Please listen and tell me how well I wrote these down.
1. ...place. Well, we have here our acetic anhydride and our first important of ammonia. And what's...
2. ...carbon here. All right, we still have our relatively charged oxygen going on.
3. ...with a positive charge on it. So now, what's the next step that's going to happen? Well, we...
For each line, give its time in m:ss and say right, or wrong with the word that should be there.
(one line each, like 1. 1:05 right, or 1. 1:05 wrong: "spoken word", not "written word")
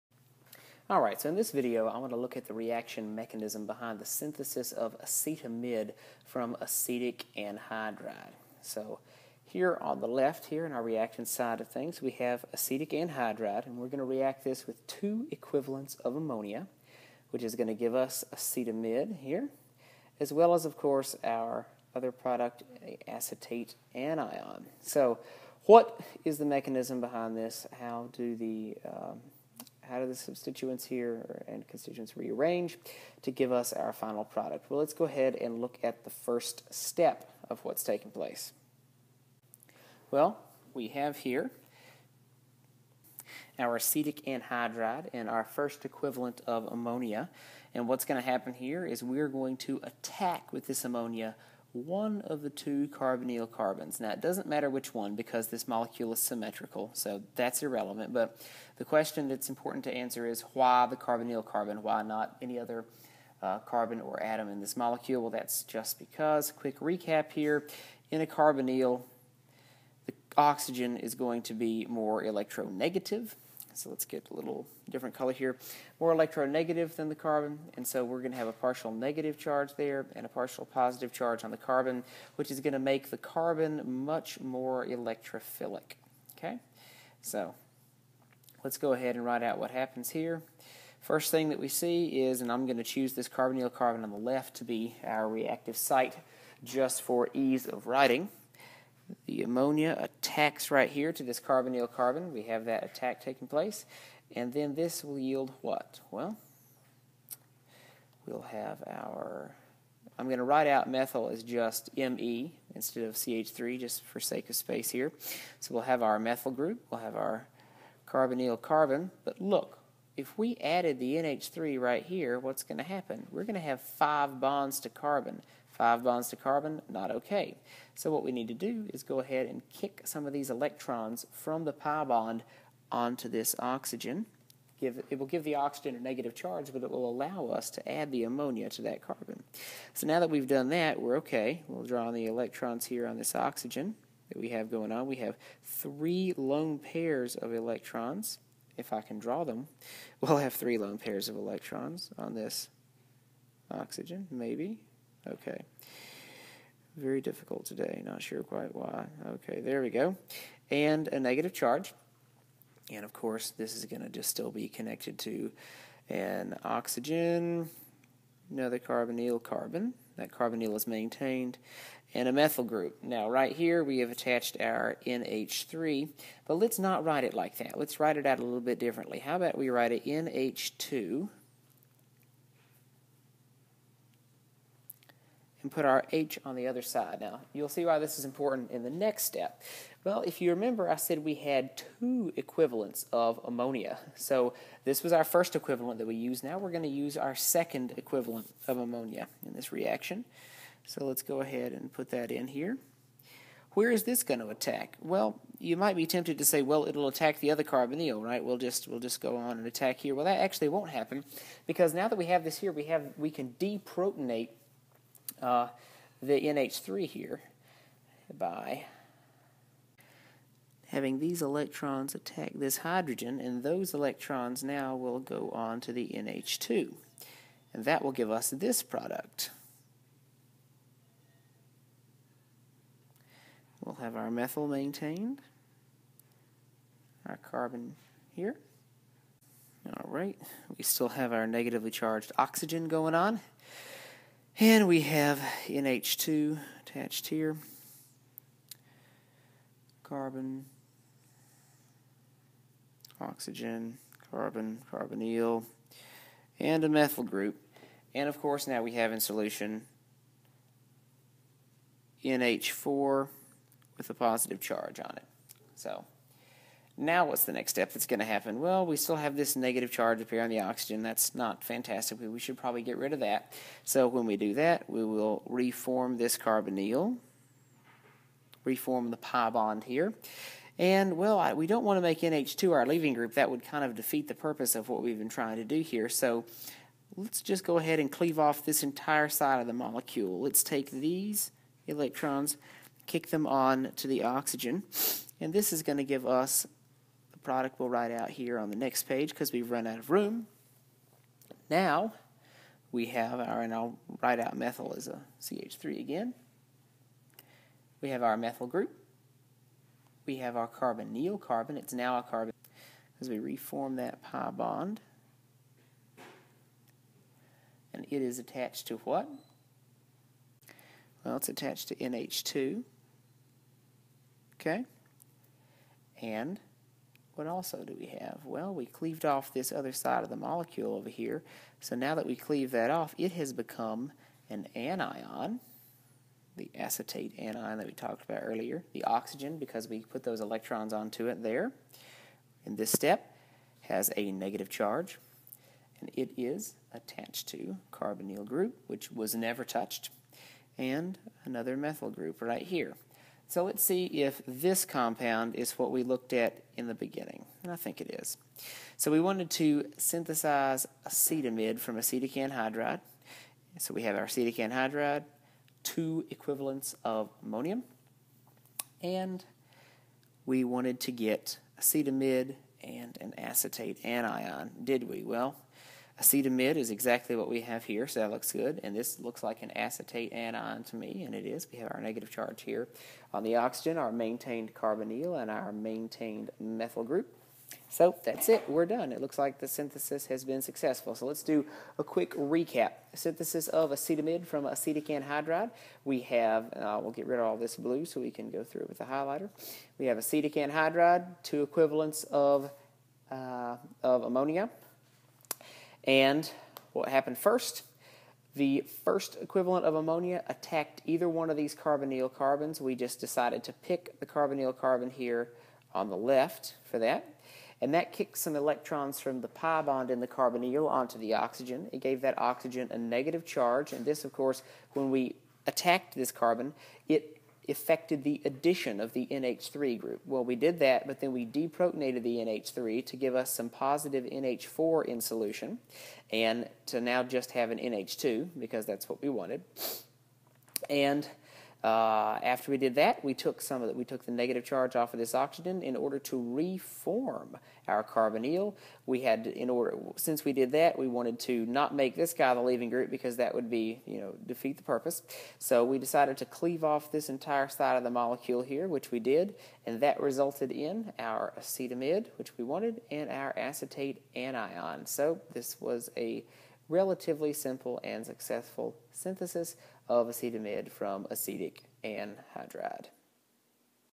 1. 0:38 wrong: "equivalent", not "important"
2. 3:57 wrong: "negatively", not "relatively"
3. 4:23 right.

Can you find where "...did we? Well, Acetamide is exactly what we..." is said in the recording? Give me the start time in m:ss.
6:14.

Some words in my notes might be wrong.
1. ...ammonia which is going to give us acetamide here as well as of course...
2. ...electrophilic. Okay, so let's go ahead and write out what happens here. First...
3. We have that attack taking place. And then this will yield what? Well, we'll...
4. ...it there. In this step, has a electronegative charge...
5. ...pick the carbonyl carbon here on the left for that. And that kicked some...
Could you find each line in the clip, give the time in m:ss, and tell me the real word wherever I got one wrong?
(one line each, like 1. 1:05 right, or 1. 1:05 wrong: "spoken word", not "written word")
1. 0:16 right
2. 1:24 right
3. 1:42 right
4. 5:41 wrong: "negative", not "electronegative"
5. 6:53 right.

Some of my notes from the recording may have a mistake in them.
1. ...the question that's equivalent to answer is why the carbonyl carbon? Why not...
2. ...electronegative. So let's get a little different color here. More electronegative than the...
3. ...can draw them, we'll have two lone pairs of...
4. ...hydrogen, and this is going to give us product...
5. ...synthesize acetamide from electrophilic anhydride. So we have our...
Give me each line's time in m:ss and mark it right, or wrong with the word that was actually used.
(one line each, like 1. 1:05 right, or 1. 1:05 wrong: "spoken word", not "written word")
1. 0:58 wrong: "important", not "equivalent"
2. 1:12 right
3. 2:29 wrong: "three", not "two"
4. 4:54 wrong: "oxygen", not "hydrogen"
5. 5:59 wrong: "acetic", not "electrophilic".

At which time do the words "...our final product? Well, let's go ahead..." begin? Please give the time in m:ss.
0:33.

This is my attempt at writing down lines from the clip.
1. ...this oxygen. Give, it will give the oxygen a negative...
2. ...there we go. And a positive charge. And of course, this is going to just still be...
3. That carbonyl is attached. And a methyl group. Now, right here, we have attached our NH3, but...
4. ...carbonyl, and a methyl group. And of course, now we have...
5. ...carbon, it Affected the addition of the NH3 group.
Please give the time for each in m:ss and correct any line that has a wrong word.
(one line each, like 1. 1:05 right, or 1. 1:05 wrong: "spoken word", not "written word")
1. 2:13 right
2. 2:39 wrong: "negative", not "positive"
3. 2:50 wrong: "maintained", not "attached"
4. 4:14 right
5. 7:06 right.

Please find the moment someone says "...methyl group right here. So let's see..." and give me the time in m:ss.
5:51.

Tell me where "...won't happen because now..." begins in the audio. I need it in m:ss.
3:30.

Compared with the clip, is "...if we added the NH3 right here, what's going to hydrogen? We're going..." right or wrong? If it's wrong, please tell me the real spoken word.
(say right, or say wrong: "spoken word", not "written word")
wrong: "happen", not "hydrogen".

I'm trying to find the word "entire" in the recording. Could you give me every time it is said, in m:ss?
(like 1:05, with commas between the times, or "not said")
4:48, 7:37.